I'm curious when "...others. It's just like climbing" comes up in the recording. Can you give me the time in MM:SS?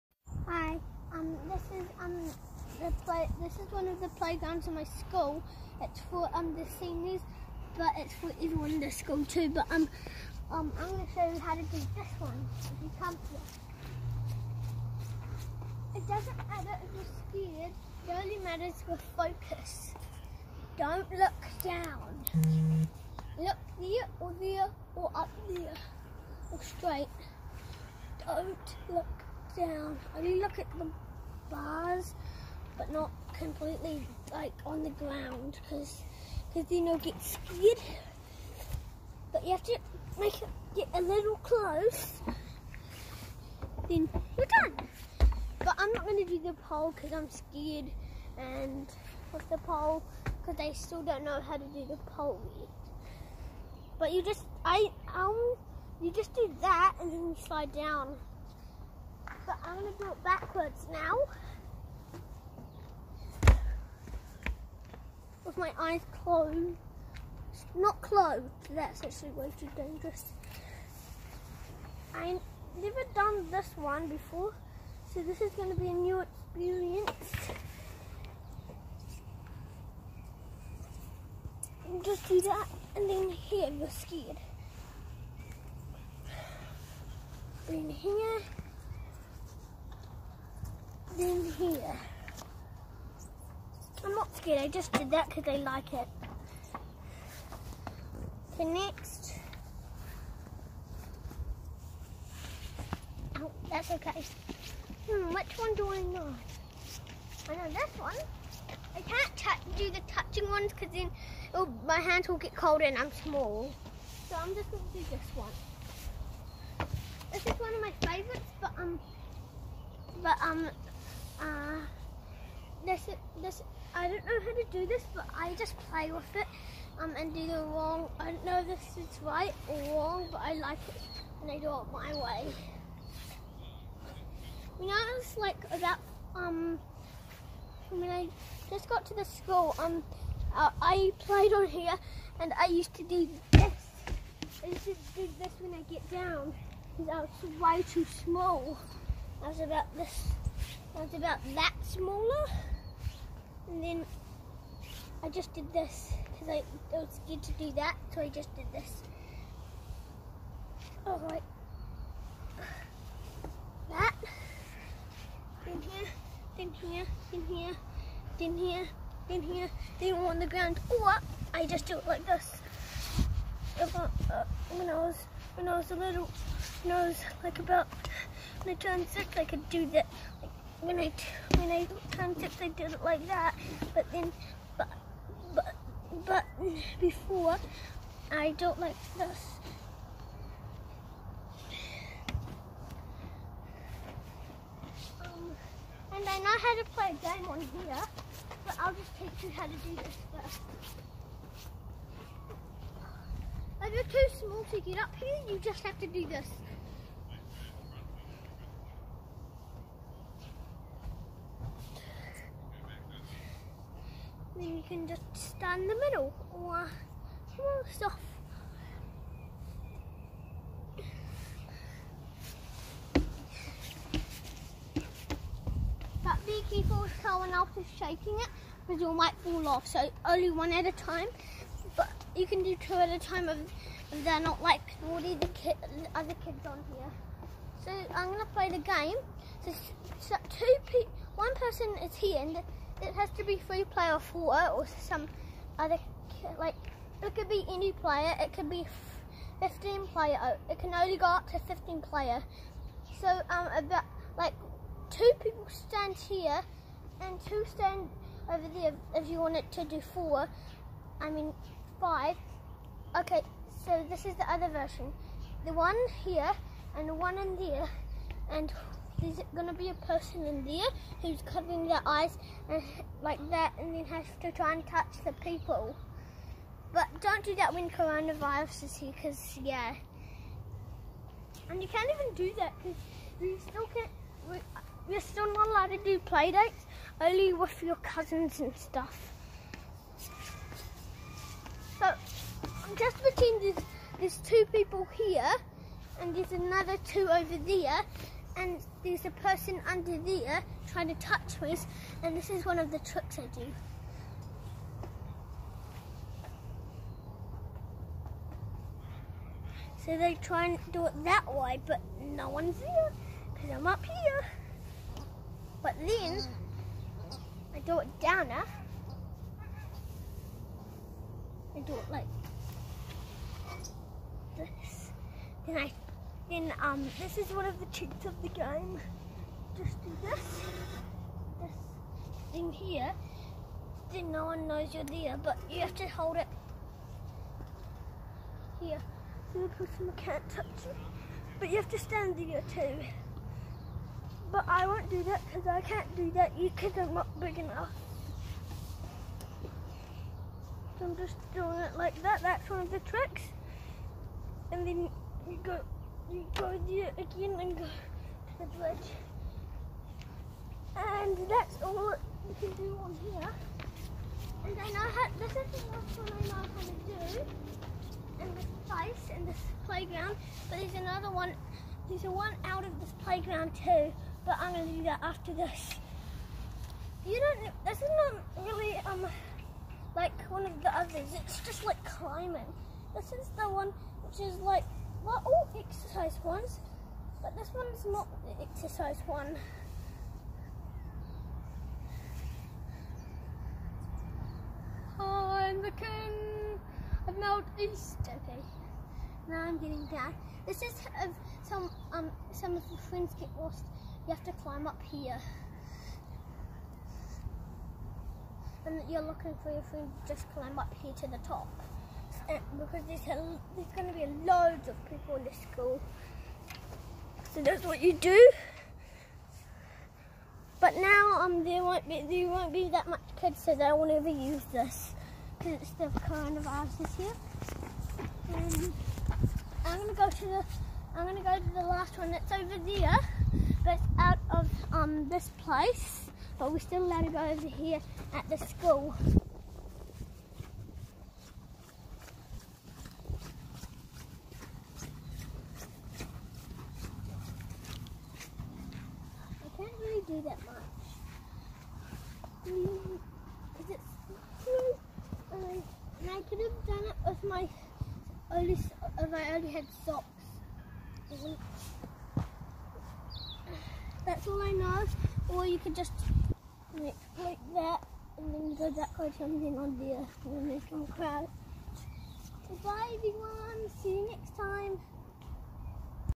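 06:20.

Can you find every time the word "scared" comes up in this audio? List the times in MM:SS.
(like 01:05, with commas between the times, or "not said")
00:17, 00:37, 00:47, 01:23, 01:34, 02:37.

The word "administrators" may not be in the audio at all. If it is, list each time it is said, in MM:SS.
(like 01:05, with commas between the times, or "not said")
not said.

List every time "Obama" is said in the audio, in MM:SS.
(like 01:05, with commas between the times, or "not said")
not said.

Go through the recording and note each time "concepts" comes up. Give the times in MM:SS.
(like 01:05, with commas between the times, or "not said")
03:02.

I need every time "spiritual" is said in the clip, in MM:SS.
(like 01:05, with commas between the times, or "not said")
not said.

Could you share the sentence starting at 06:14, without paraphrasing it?
But I'm going to do that after this.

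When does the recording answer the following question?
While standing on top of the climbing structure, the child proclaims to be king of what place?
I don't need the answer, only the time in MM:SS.
06:37.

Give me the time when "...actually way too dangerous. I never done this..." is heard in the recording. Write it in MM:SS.
01:09.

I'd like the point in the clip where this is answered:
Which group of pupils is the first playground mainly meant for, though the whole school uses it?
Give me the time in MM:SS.
00:06.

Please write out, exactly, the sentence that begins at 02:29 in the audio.
I was about this that's about that smaller.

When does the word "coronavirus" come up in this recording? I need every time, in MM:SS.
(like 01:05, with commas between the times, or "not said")
04:37, 07:06.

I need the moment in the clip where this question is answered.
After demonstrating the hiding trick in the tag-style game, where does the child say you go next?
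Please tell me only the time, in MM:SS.
05:58.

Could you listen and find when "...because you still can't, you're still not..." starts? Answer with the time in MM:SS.
04:42.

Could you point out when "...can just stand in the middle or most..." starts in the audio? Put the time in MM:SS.
03:34.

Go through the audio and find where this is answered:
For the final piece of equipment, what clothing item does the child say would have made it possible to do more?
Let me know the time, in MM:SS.
07:40.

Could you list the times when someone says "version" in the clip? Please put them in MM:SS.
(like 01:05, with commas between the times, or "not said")
04:24.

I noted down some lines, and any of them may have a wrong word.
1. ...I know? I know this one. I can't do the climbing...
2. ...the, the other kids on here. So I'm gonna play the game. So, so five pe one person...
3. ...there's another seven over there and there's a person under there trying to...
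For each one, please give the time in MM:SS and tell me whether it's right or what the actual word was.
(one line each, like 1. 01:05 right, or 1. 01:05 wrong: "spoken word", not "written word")
1. 01:45 wrong: "touching", not "climbing"
2. 03:55 wrong: "two", not "five"
3. 04:56 wrong: "two", not "seven".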